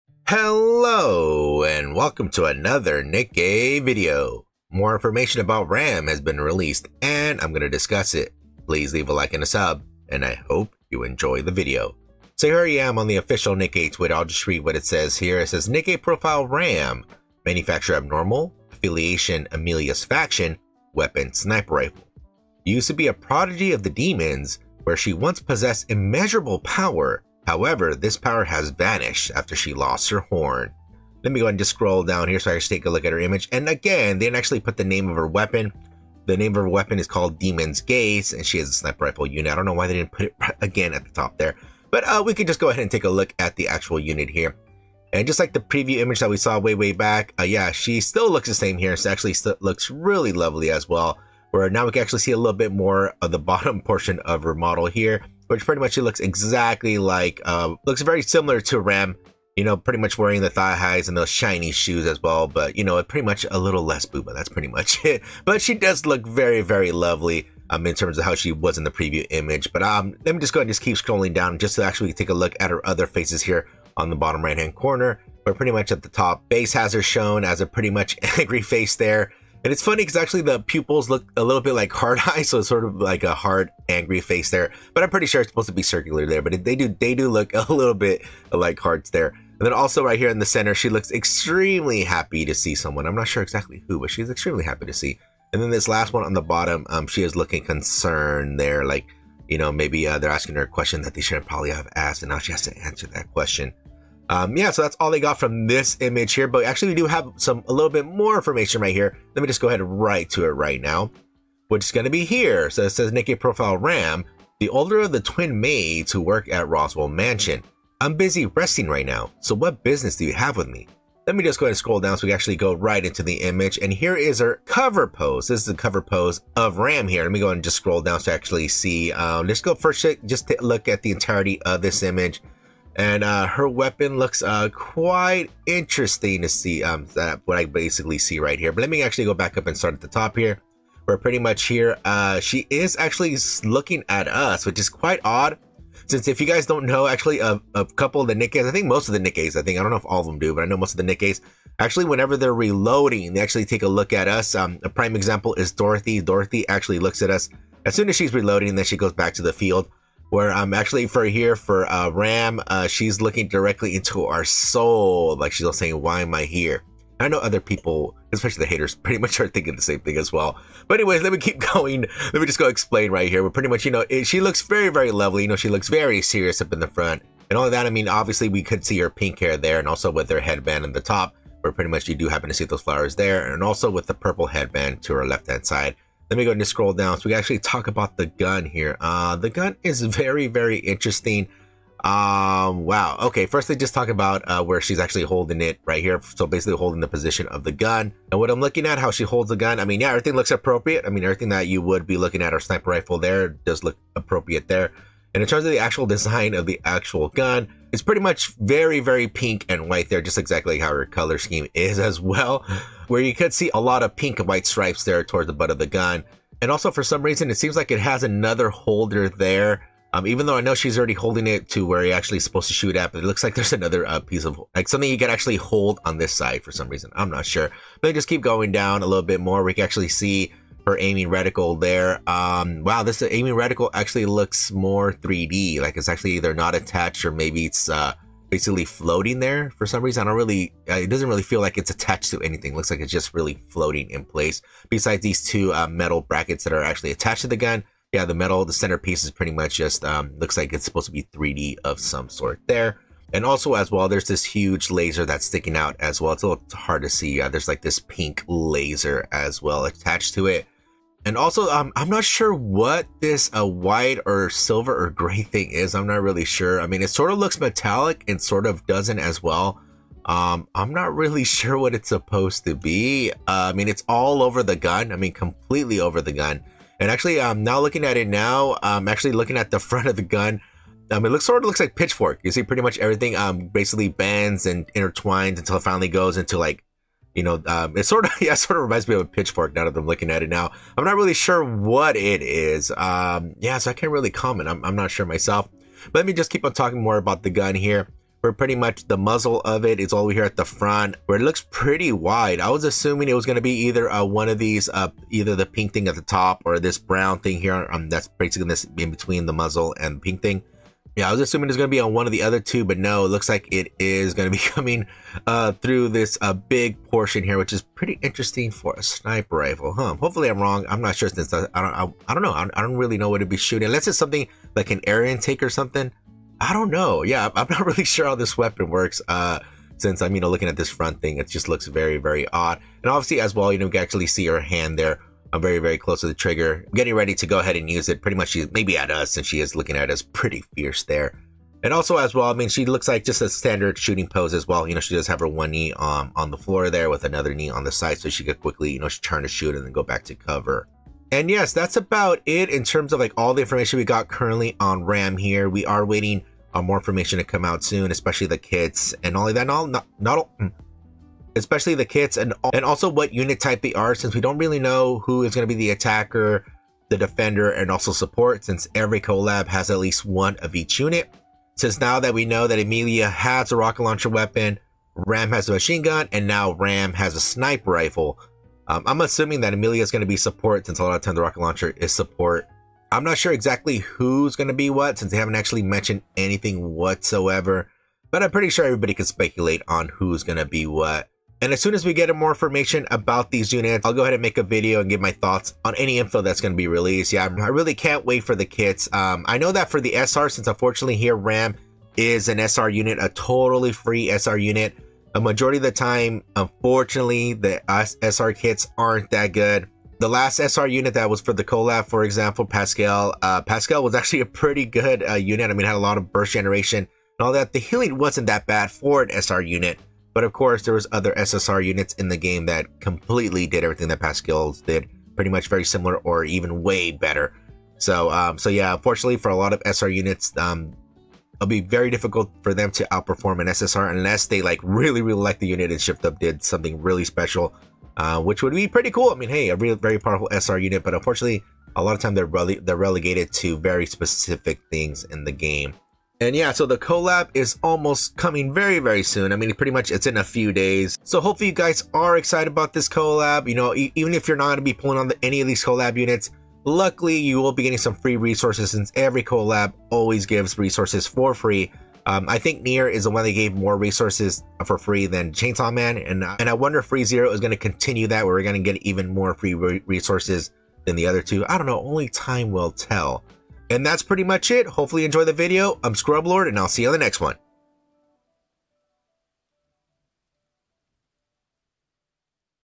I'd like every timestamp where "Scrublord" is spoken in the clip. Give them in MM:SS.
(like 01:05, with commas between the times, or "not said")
07:56.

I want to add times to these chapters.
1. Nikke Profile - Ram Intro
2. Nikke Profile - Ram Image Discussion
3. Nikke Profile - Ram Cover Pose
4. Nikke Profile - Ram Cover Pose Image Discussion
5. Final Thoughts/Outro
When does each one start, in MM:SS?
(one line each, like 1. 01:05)
1. 00:12
2. 00:33
3. 01:51
4. 02:03
5. 05:51.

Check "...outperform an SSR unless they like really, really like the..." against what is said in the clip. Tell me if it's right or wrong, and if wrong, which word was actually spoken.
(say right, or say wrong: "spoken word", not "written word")
right.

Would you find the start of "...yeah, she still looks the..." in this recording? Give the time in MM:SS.
00:47.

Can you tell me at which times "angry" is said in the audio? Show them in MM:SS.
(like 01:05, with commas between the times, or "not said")
01:18, 01:23.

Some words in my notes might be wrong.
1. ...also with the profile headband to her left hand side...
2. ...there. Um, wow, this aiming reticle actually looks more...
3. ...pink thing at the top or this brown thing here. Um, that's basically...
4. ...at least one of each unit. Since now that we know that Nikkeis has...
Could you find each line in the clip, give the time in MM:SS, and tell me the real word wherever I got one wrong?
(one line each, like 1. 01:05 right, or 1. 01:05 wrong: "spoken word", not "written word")
1. 03:03 wrong: "purple", not "profile"
2. 03:51 right
3. 05:05 right
4. 06:09 wrong: "Emilia", not "Nikkeis".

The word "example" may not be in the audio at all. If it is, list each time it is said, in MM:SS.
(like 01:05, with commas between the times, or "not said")
02:35, 06:52.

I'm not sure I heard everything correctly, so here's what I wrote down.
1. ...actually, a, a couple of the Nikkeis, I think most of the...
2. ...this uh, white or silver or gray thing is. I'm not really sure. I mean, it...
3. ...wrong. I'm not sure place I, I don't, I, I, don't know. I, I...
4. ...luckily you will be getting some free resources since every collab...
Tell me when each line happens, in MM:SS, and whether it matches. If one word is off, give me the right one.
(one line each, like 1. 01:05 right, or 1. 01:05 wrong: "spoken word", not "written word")
1. 02:27 right
2. 04:23 right
3. 05:20 wrong: "since", not "place"
4. 07:36 right.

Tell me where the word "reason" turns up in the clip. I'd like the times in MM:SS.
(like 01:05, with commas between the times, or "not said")
03:37, 03:46, 04:00.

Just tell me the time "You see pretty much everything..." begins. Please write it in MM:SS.
04:42.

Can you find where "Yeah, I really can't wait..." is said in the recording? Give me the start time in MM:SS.
06:37.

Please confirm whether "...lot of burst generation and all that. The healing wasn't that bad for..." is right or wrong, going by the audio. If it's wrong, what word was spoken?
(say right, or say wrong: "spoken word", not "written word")
right.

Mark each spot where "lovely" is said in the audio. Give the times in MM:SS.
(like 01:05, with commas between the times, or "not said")
00:50, 01:06, 02:55.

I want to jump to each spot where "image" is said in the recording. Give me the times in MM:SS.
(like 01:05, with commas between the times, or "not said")
00:33, 00:45, 01:09, 01:45, 02:03, 02:12.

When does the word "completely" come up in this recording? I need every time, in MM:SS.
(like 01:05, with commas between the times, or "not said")
04:35, 07:03.